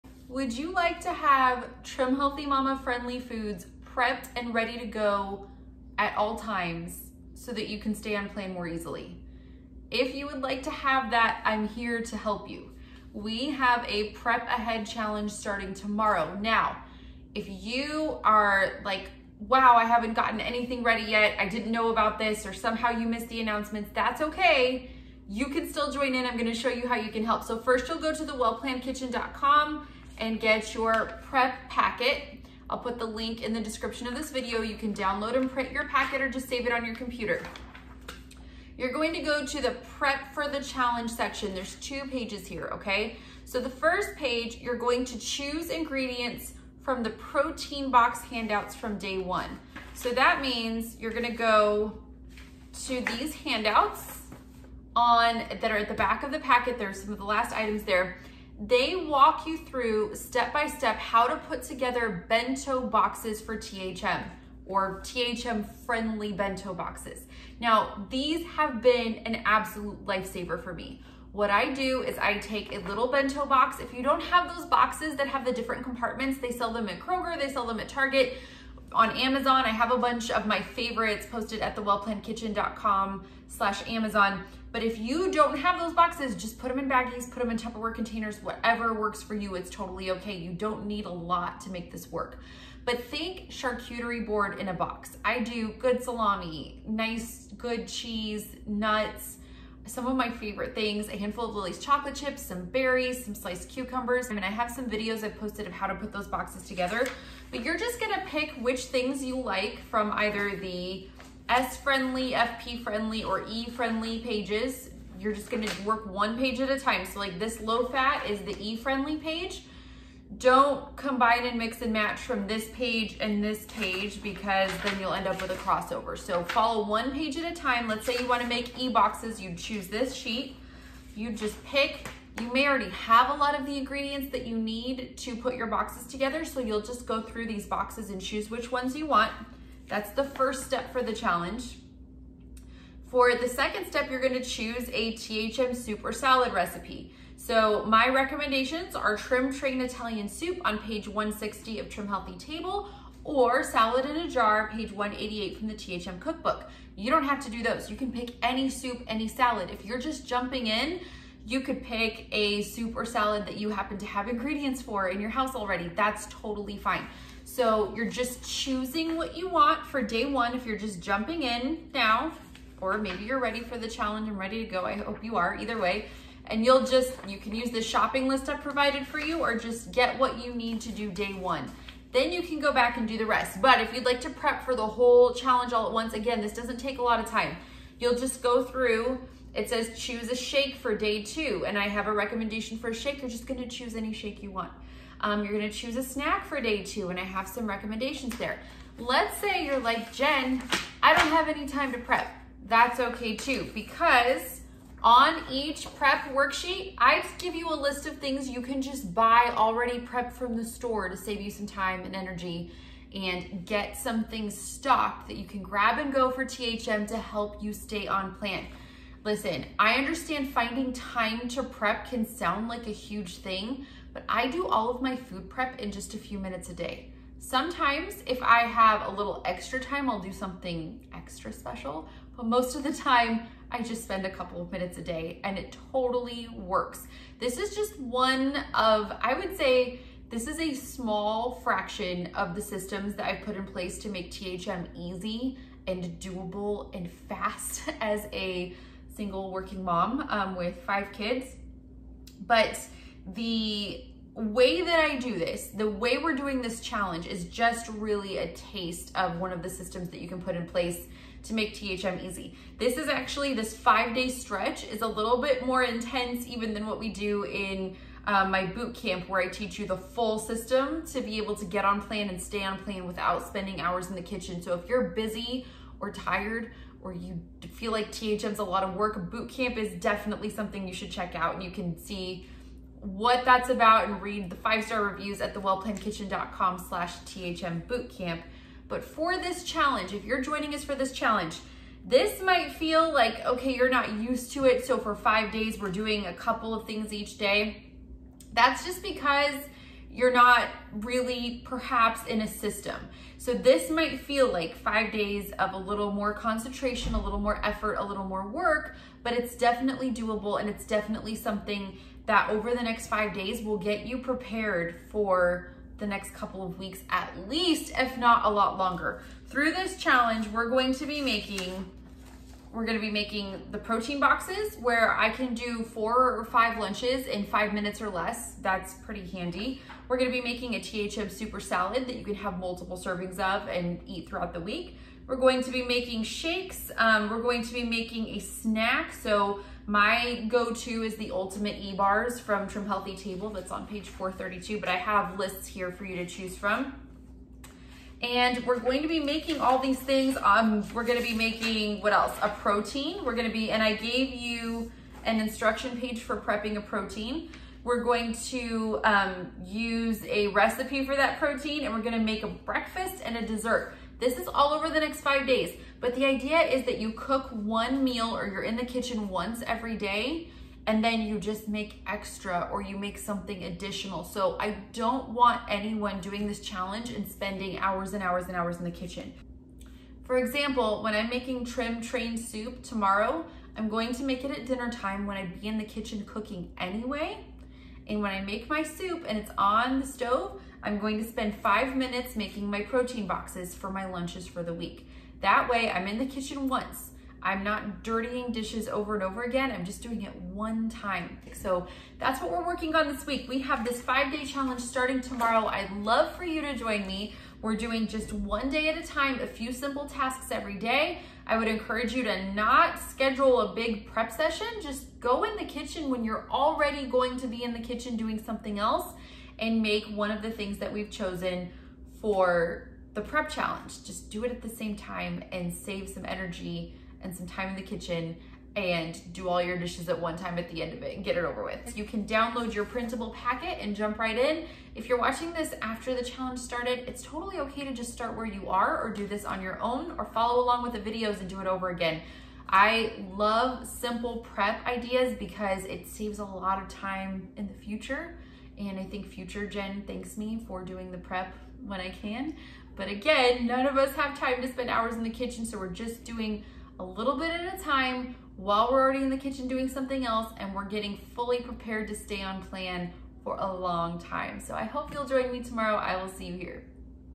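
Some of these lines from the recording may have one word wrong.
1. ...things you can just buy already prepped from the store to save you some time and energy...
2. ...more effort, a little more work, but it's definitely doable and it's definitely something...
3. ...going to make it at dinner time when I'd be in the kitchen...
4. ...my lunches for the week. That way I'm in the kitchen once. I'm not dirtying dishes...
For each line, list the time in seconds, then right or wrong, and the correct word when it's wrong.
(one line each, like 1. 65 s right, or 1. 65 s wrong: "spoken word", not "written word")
1. 208 s right
2. 307 s right
3. 383 s right
4. 393 s right.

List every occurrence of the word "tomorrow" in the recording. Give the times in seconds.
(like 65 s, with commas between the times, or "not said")
15 s, 382 s, 405 s, 465 s.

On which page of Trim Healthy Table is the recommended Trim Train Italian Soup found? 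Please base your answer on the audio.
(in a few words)
160.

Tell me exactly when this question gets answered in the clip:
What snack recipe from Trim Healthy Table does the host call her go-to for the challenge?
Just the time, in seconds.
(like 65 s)
341 s.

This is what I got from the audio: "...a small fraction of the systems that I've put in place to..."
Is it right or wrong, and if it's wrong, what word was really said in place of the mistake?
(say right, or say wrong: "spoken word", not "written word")
right.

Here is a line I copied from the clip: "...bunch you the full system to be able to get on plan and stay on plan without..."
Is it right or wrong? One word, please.
wrong.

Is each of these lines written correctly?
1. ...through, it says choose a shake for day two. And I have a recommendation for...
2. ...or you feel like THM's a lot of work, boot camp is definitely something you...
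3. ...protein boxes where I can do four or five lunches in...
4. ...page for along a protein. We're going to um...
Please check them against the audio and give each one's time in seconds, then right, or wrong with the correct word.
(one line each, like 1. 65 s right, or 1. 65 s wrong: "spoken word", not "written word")
1. 188 s right
2. 277 s right
3. 323 s right
4. 355 s wrong: "prepping", not "along".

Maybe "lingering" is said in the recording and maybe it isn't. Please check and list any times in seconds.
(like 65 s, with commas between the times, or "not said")
not said.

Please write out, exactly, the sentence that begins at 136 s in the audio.
So you'll just go through these boxes and choose which ones you want.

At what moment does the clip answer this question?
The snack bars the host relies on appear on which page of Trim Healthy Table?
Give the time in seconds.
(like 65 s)
344 s.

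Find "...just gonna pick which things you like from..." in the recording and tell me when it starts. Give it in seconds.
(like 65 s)
107 s.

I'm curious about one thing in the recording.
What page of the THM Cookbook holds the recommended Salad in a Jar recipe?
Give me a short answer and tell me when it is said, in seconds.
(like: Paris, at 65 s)
188, at 154 s.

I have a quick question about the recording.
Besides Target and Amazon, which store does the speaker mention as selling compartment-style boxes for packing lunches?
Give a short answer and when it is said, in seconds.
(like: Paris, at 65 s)
Kroger, at 76 s.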